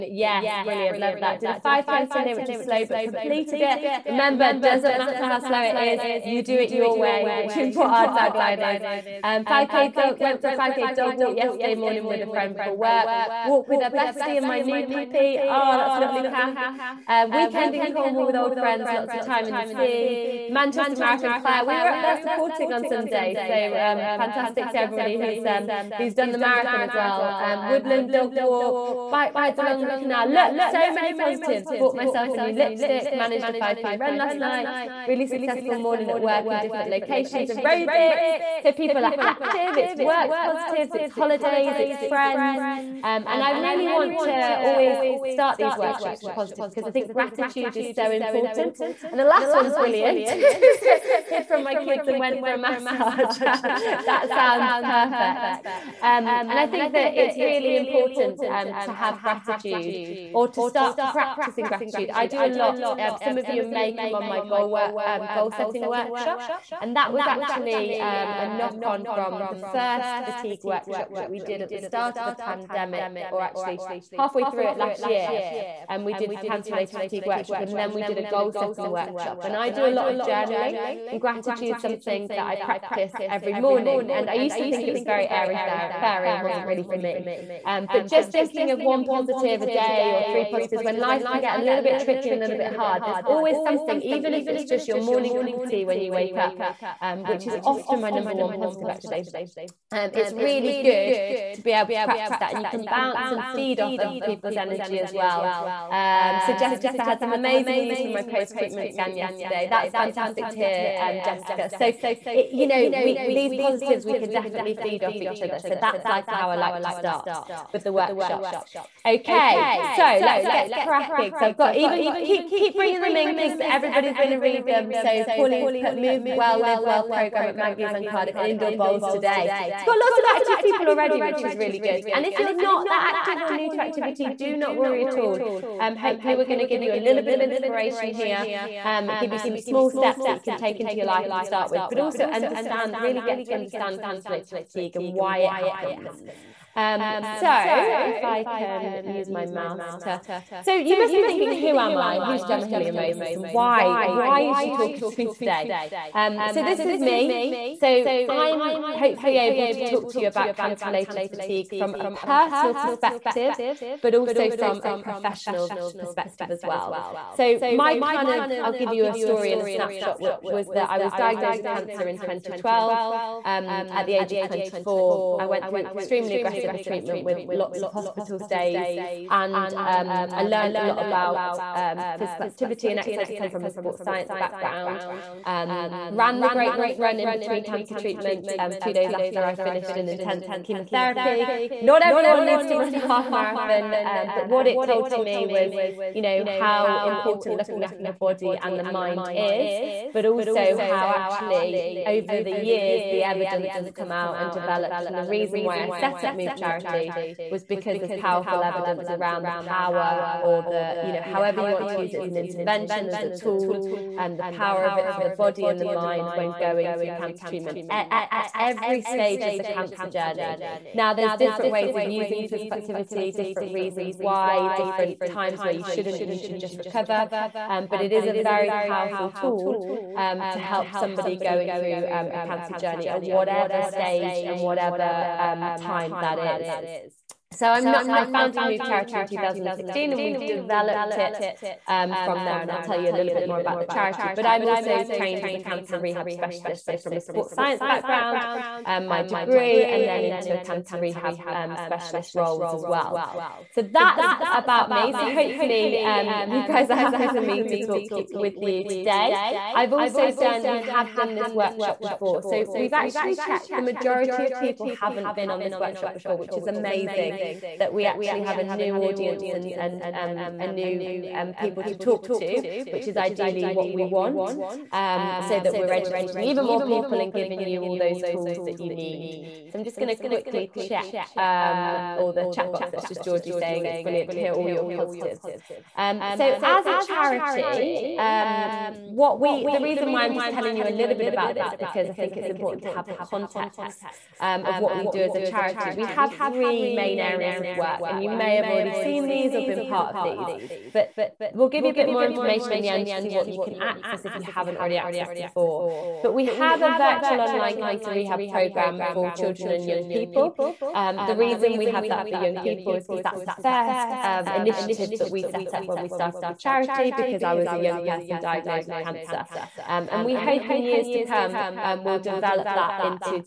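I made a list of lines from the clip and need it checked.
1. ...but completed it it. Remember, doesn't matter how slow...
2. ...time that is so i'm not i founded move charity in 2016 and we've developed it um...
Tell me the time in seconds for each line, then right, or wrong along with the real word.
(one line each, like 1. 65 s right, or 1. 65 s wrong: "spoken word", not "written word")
1. 2 s right
2. 235 s right.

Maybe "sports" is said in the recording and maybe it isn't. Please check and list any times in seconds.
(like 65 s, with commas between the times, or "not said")
183 s, 247 s.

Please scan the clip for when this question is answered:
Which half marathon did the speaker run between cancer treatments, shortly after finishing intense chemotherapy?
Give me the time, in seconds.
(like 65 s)
186 s.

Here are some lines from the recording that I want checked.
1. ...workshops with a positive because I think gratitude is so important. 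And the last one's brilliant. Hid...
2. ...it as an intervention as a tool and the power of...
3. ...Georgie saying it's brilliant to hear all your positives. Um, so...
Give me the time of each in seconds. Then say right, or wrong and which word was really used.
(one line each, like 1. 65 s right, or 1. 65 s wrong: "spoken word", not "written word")
1. 45 s right
2. 212 s right
3. 283 s right.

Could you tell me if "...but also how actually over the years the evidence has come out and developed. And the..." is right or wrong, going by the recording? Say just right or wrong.
right.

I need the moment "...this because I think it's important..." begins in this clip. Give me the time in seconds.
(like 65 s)
291 s.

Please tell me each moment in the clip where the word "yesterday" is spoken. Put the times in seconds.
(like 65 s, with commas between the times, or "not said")
11 s, 109 s.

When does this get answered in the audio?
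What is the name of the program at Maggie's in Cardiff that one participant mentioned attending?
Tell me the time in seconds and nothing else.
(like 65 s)
125 s.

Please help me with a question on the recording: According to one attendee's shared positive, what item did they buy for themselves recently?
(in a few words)
A new lipstick.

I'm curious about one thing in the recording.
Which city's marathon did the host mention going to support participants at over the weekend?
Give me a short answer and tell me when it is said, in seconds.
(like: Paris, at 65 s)
Manchester, at 20 s.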